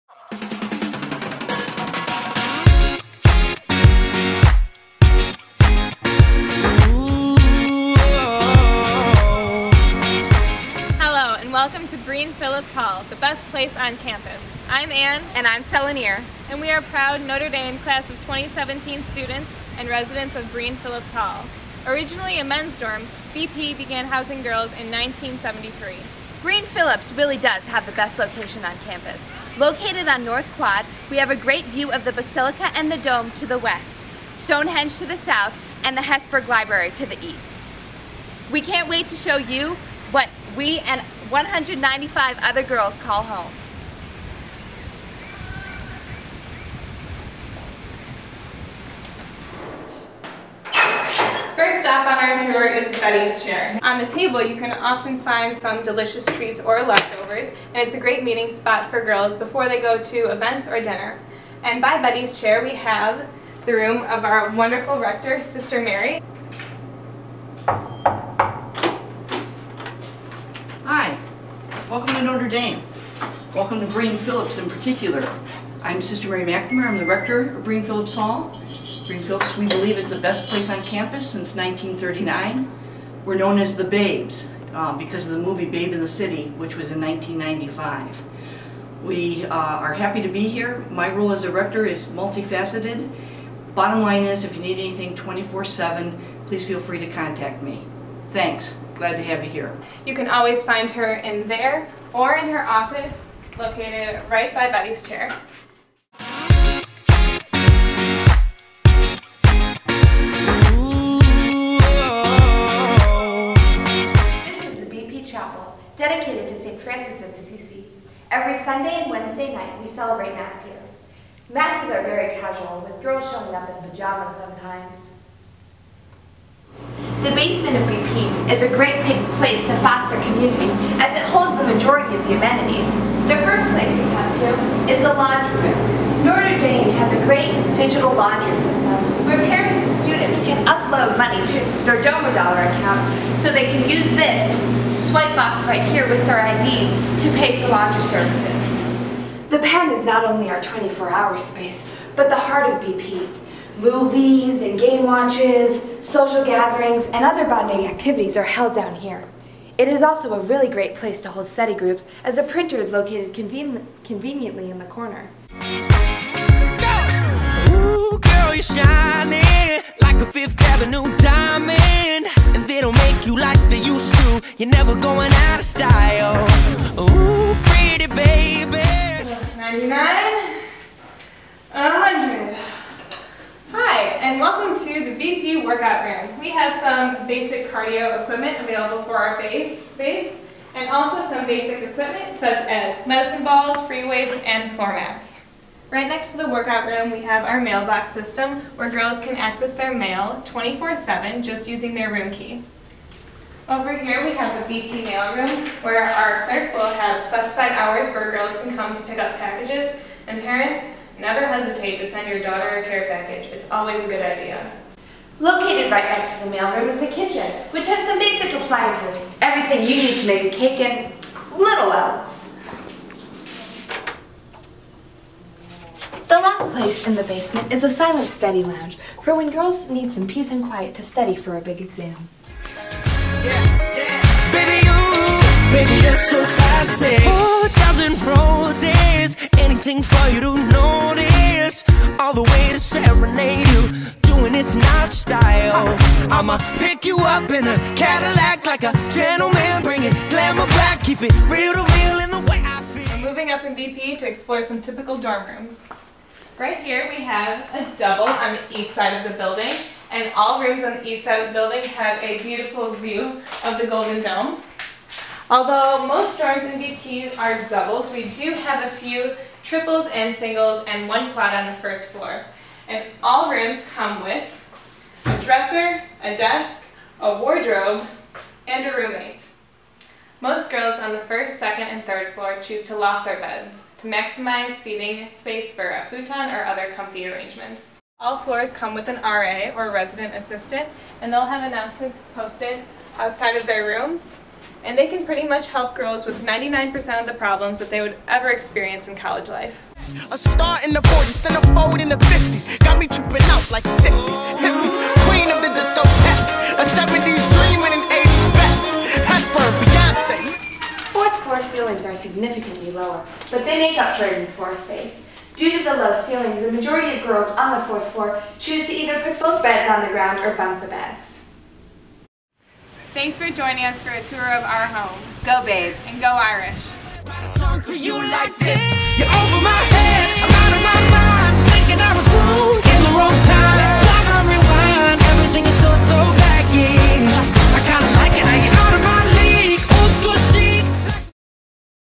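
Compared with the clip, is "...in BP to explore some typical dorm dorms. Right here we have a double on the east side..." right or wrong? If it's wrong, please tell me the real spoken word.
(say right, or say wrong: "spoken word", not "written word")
wrong: "rooms", not "dorms".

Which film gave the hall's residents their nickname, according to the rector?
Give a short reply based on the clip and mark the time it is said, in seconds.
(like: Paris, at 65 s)
Babe in the City, at 85 s.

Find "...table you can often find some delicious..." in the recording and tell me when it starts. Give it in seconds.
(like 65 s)
54 s.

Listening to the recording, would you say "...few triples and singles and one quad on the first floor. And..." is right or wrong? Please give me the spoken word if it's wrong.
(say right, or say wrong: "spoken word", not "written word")
right.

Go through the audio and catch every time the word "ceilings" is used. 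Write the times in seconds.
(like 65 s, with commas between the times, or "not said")
311 s, 316 s.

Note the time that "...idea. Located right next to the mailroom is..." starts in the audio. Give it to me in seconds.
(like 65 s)
214 s.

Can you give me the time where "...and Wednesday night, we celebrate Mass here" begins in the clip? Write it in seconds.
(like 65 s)
119 s.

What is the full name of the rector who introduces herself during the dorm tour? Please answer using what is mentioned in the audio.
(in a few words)
Sister Mary McNamara.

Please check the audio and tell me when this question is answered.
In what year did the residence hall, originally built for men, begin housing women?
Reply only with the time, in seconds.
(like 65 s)
24 s.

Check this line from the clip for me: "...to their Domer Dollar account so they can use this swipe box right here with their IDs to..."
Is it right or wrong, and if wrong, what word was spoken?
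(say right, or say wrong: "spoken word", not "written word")
right.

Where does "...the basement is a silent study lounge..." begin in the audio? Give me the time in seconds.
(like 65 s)
227 s.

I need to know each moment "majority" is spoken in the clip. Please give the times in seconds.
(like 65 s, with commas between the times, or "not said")
131 s, 316 s.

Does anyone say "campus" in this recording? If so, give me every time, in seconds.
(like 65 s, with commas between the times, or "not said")
13 s, 28 s, 80 s.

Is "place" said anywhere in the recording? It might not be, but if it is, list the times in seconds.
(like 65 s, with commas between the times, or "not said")
13 s, 80 s, 129 s, 133 s, 160 s, 226 s.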